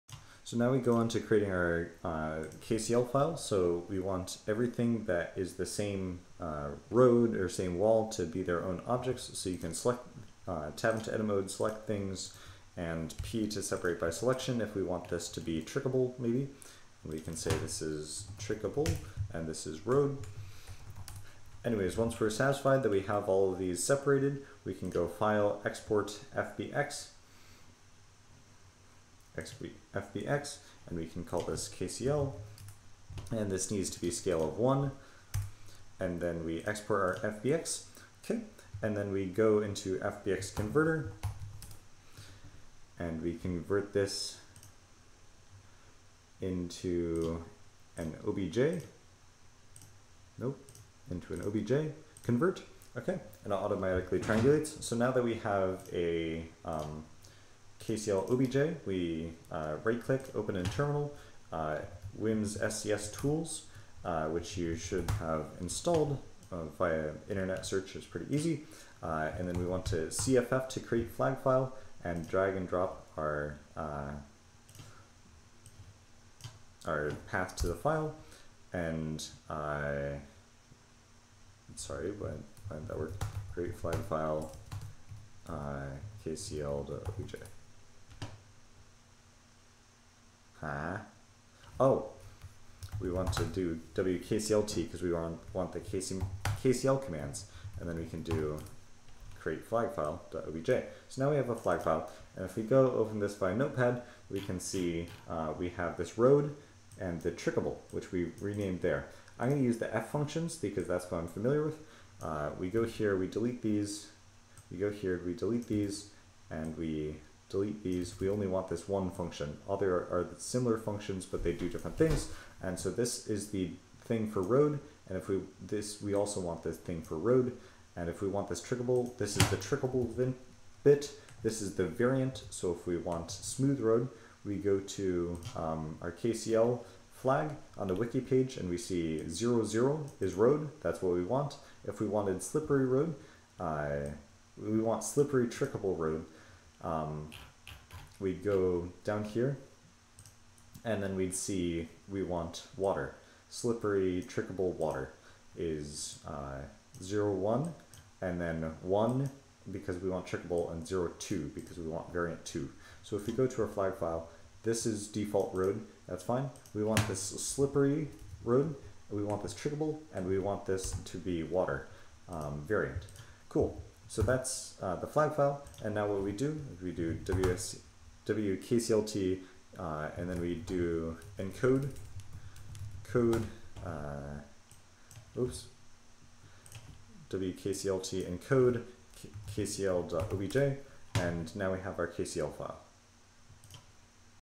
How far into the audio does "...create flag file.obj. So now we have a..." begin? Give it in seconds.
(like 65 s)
99 s.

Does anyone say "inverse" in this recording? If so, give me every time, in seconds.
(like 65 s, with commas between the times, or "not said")
not said.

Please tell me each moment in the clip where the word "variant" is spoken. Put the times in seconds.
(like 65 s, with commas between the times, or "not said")
131 s, 162 s, 172 s.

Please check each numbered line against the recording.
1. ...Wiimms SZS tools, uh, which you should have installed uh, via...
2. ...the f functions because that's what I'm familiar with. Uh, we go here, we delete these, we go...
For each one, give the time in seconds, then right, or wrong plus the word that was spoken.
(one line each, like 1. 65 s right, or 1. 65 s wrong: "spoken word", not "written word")
1. 62 s right
2. 109 s right.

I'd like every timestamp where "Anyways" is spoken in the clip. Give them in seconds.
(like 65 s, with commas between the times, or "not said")
21 s.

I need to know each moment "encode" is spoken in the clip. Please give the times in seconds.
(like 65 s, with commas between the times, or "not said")
181 s, 188 s.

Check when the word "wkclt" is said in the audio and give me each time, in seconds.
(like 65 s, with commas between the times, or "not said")
93 s, 178 s, 187 s.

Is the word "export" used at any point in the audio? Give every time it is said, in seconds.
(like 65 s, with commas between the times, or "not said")
25 s, 36 s.